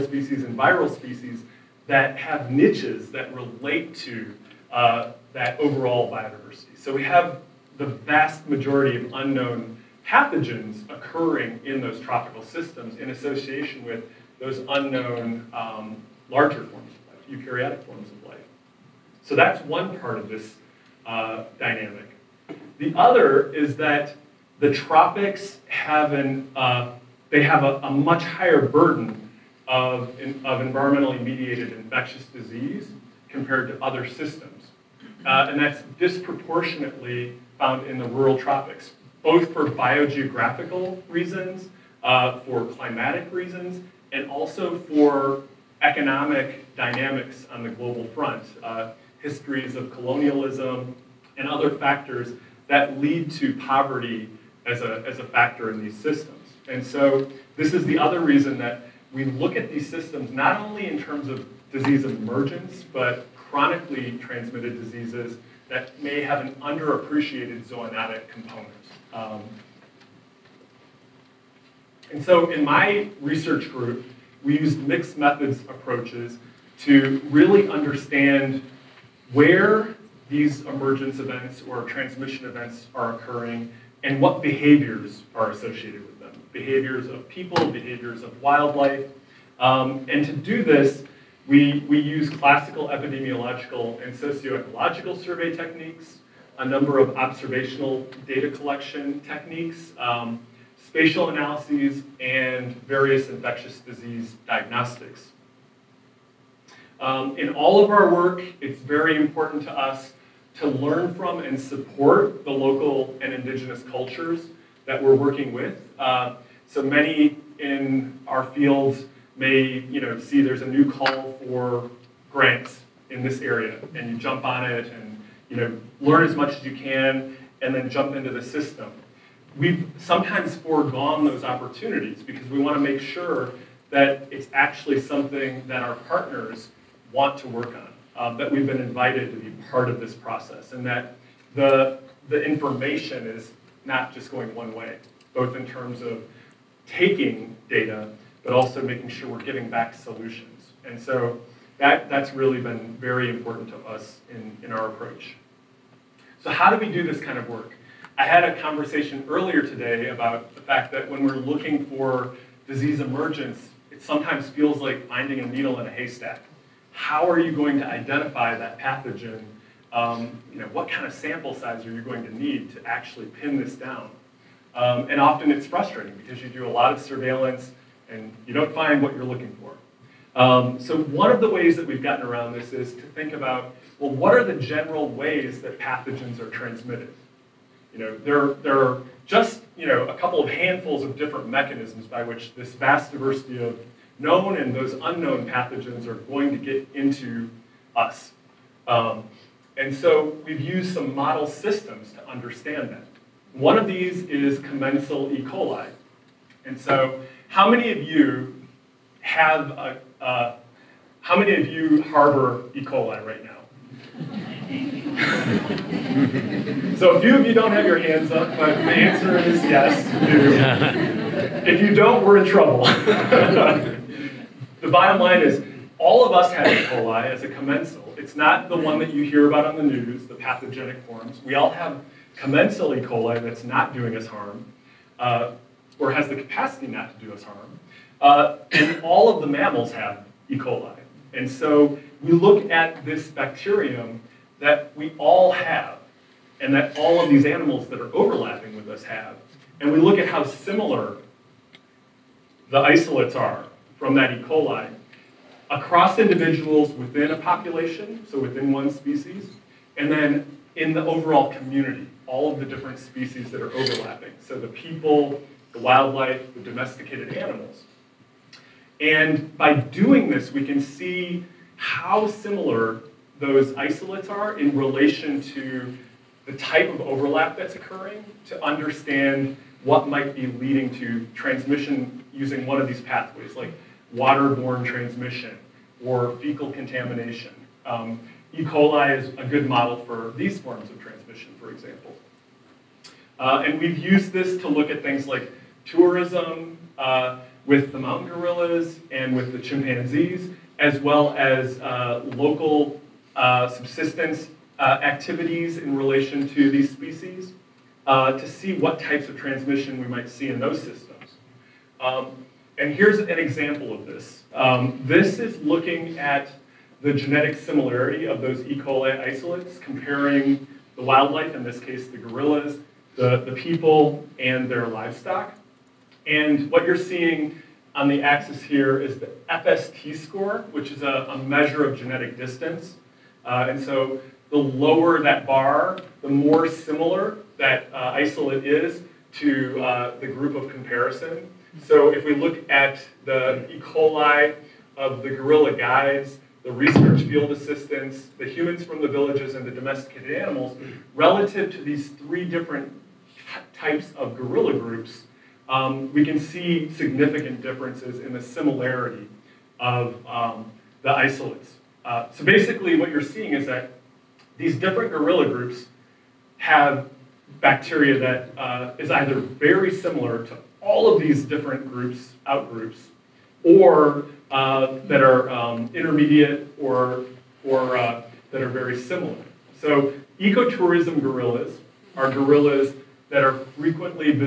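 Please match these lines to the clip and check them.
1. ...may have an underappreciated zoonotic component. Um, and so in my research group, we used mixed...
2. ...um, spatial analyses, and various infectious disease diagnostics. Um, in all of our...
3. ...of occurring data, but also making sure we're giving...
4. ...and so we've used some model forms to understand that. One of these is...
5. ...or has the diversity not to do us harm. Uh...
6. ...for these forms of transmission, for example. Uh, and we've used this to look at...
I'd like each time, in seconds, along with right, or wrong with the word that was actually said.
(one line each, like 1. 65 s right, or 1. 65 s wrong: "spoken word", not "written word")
1. 66 s right
2. 99 s right
3. 146 s wrong: "taking", not "occurring"
4. 199 s wrong: "systems", not "forms"
5. 235 s wrong: "capacity", not "diversity"
6. 289 s right.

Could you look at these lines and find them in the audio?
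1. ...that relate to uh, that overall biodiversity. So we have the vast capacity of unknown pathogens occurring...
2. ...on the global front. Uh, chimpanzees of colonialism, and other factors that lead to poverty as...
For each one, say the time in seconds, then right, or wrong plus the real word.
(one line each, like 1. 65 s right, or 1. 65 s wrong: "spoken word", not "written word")
1. 3 s wrong: "majority", not "capacity"
2. 47 s wrong: "histories", not "chimpanzees".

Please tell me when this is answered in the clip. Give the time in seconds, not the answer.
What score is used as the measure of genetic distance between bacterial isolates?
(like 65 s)
329 s.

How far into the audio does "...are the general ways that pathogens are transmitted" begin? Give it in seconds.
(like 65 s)
184 s.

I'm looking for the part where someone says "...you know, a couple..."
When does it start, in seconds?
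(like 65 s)
189 s.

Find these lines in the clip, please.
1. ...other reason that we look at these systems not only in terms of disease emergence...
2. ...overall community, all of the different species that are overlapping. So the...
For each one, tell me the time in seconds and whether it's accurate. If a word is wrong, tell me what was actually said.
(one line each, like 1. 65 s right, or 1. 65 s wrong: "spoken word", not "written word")
1. 57 s right
2. 261 s right.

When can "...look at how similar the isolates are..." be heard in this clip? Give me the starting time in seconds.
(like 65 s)
249 s.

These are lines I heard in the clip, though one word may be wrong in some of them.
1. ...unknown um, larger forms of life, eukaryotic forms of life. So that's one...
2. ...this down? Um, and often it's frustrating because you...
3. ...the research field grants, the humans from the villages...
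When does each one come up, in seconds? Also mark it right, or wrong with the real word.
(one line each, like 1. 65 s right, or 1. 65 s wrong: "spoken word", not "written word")
1. 14 s right
2. 173 s right
3. 346 s wrong: "assistants", not "grants".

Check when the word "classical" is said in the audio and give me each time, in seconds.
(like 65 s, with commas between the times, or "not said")
92 s.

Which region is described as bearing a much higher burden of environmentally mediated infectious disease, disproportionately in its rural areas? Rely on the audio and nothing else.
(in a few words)
the tropics.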